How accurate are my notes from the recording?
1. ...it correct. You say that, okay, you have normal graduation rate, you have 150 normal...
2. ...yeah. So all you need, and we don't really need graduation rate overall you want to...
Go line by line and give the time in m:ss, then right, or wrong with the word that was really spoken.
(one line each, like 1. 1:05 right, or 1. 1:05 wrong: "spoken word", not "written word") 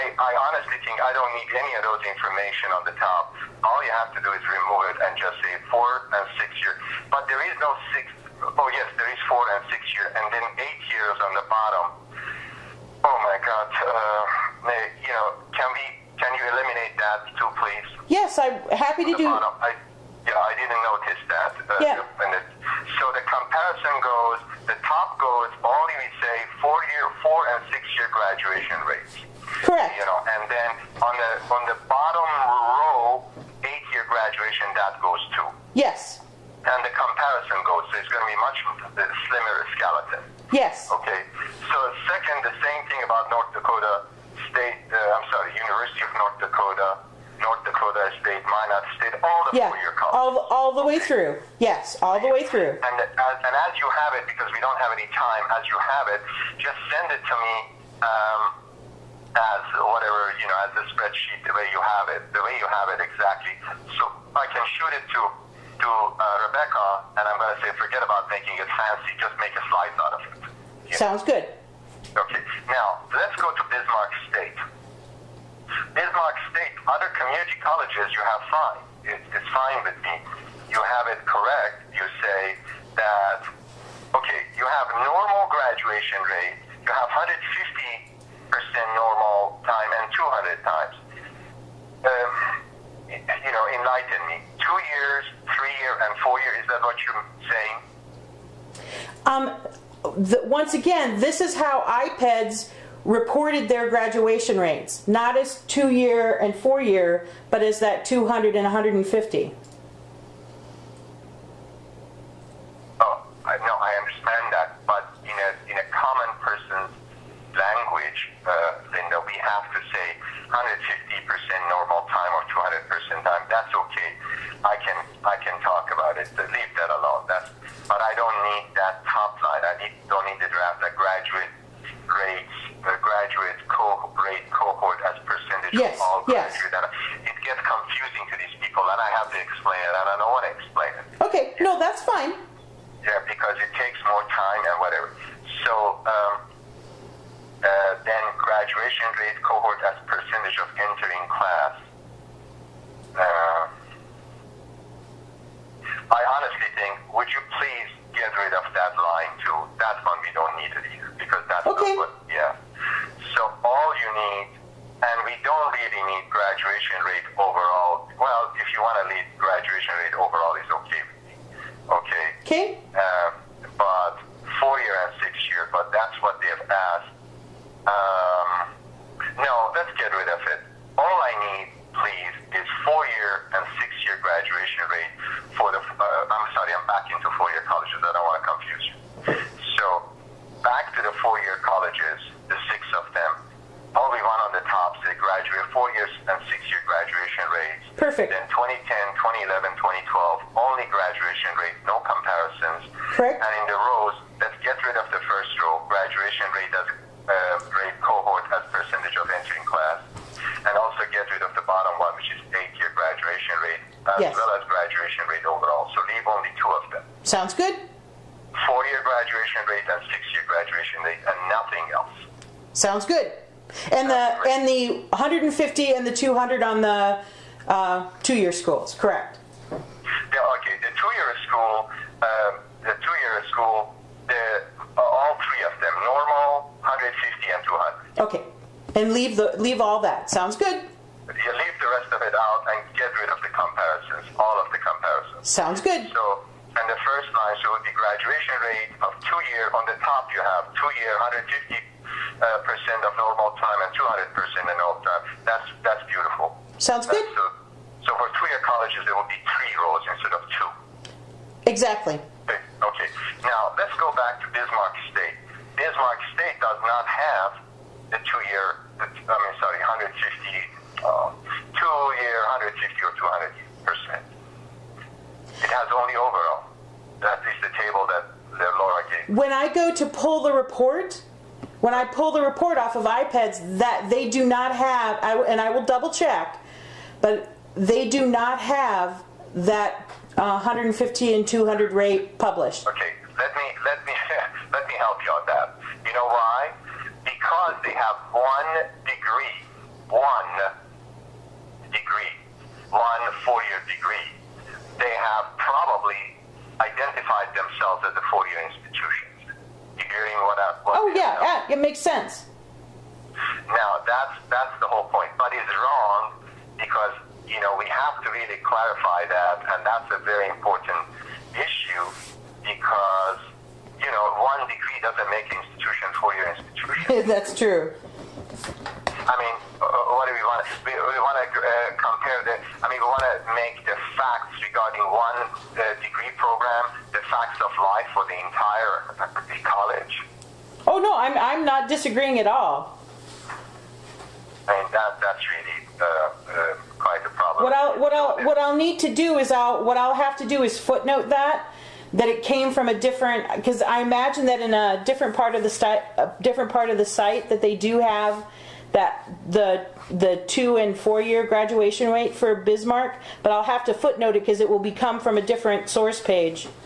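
1. 1:21 right
2. 2:42 right.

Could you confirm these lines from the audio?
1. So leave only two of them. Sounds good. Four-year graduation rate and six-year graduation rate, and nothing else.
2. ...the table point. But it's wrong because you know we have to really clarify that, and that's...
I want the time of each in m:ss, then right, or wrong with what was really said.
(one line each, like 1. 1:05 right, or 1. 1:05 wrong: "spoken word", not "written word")
1. 3:35 right
2. 5:14 wrong: "whole", not "table".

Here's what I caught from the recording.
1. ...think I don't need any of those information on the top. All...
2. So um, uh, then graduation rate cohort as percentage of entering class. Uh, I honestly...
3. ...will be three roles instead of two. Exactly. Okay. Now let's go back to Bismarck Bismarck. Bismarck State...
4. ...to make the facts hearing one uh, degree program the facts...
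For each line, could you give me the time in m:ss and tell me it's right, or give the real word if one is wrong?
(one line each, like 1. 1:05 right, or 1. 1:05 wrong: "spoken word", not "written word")
1. 0:00 right
2. 2:25 right
3. 4:19 wrong: "State", not "Bismarck"
4. 5:33 wrong: "regarding", not "hearing".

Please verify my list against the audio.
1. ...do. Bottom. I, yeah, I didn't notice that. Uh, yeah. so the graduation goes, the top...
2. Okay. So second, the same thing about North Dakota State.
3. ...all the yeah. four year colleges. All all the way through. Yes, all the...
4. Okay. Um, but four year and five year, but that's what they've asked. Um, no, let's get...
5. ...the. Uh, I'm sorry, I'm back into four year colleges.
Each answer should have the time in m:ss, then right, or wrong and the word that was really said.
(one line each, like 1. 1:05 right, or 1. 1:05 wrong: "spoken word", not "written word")
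1. 0:19 wrong: "comparison", not "graduation"
2. 0:40 right
3. 0:49 right
4. 2:52 wrong: "six", not "five"
5. 3:05 right.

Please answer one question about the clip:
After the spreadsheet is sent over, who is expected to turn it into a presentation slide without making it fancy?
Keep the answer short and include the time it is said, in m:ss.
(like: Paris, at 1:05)
Rebecca, at 1:06.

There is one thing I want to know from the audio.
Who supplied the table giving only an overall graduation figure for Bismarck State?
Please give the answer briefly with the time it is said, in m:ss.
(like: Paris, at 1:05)
Laura, at 4:38.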